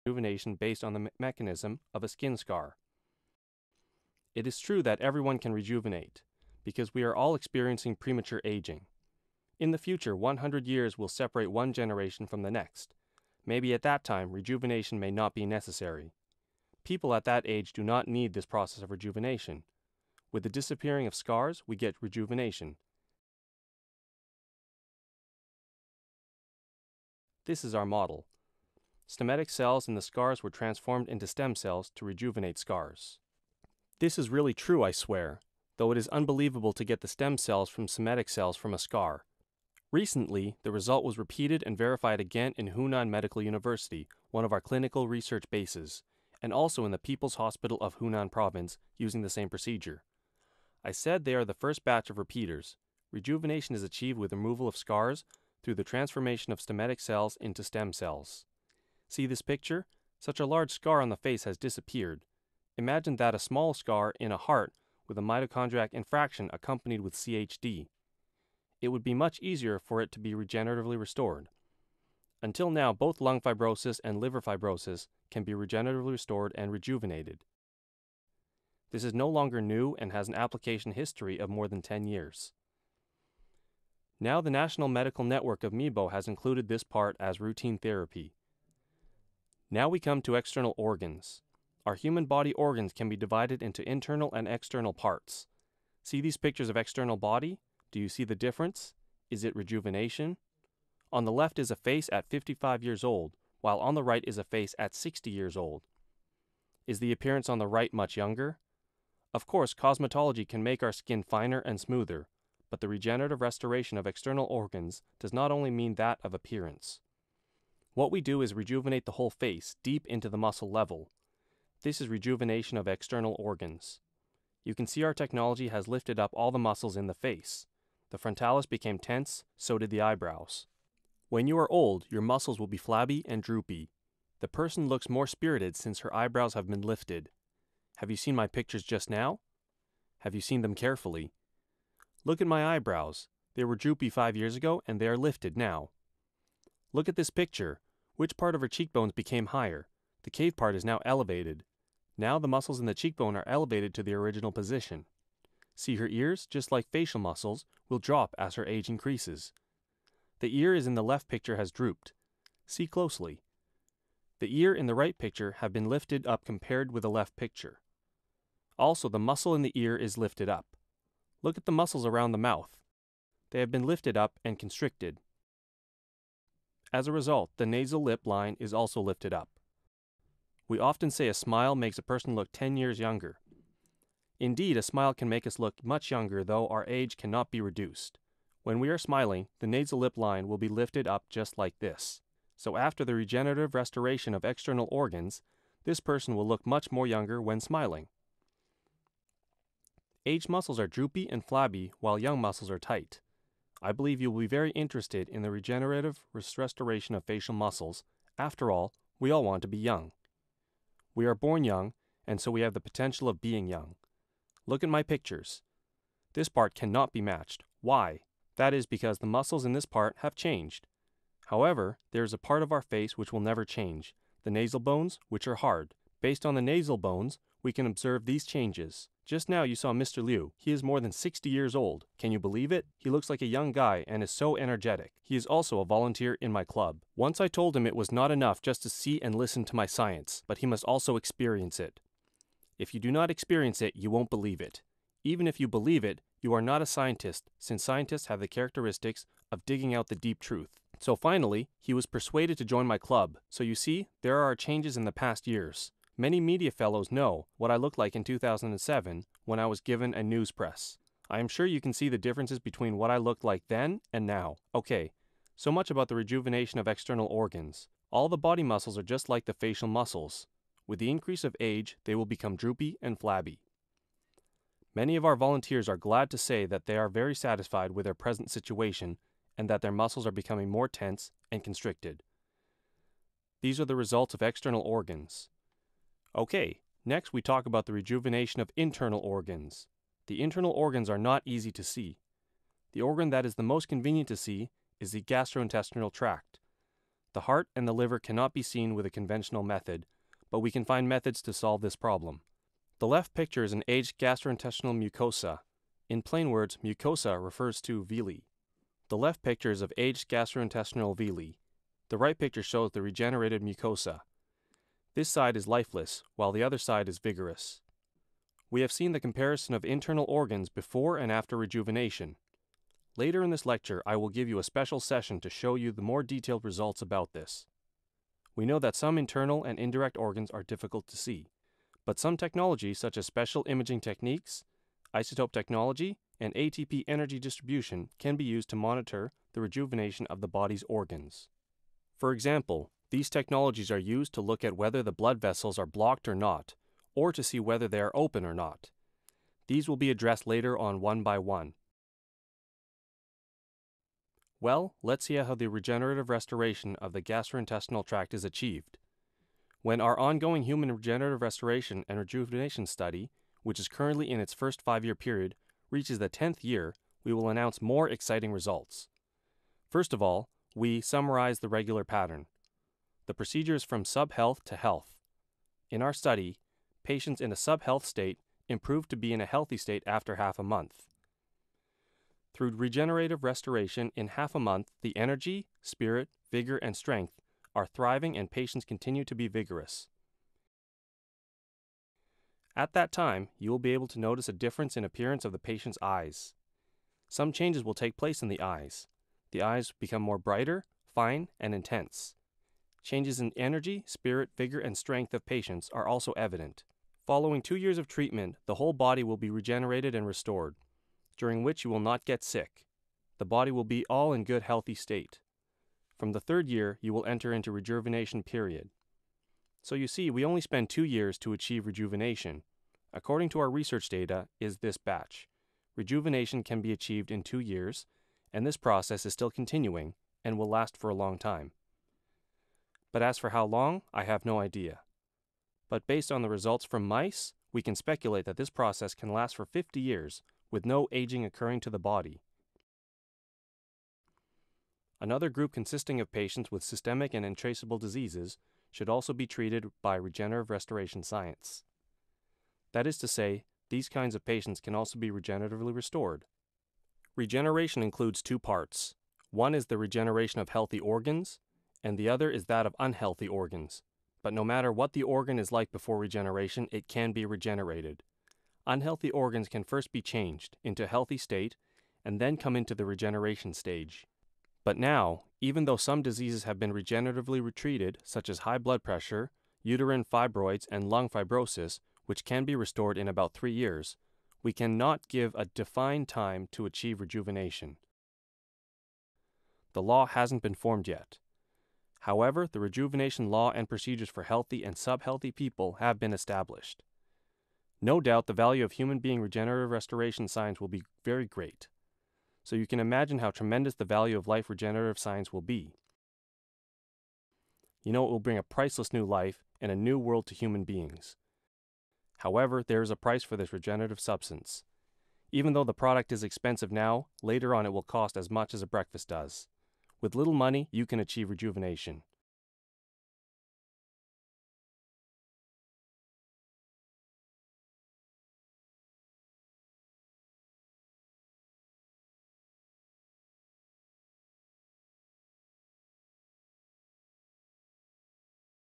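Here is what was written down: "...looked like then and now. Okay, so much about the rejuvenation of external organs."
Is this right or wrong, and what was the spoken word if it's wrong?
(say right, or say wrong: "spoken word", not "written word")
right.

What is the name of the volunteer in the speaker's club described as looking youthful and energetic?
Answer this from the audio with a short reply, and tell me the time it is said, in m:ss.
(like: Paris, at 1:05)
Mr. Liu, at 3:49.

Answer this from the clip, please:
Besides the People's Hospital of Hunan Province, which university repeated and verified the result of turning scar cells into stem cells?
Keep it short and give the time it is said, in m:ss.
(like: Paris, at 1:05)
Hunan Medical University, at 0:42.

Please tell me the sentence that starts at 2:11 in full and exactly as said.
When you are old, your muscles will be flabby and droopy.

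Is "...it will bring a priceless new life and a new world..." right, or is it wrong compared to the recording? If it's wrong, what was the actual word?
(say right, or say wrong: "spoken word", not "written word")
right.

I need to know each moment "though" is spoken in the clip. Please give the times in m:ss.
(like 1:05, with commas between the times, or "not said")
0:35, 3:06, 7:55, 8:35.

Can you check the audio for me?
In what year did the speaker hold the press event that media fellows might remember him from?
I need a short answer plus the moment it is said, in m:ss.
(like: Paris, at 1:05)
2007, at 4:18.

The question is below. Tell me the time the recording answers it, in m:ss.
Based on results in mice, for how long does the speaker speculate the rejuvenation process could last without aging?
7:19.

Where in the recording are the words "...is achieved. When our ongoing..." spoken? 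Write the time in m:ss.
5:58.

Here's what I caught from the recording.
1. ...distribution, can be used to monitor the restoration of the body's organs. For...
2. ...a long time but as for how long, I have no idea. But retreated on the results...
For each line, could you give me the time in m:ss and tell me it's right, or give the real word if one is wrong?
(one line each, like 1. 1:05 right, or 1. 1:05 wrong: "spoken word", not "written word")
1. 5:37 wrong: "rejuvenation", not "restoration"
2. 7:11 wrong: "based", not "retreated".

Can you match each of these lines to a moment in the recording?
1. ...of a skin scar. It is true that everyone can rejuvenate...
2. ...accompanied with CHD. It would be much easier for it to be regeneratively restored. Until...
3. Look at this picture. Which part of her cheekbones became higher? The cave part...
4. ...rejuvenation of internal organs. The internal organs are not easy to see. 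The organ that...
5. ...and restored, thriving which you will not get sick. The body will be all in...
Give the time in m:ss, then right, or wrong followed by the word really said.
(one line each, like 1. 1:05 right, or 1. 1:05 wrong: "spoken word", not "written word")
1. 0:01 right
2. 1:06 right
3. 2:26 right
4. 4:47 right
5. 6:50 wrong: "during", not "thriving".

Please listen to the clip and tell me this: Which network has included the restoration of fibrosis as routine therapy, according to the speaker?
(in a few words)
National Medical Network of MEBO.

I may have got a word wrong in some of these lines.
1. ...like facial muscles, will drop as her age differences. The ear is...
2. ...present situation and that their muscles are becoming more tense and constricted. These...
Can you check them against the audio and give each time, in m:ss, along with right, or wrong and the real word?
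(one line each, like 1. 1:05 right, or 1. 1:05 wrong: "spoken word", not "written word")
1. 2:36 wrong: "increases", not "differences"
2. 4:38 right.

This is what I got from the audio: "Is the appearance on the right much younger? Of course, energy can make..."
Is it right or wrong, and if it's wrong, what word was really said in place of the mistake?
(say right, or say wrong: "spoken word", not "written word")
wrong: "cosmetology", not "energy".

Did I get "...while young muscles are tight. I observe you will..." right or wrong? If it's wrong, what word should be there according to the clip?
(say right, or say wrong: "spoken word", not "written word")
wrong: "believe", not "observe".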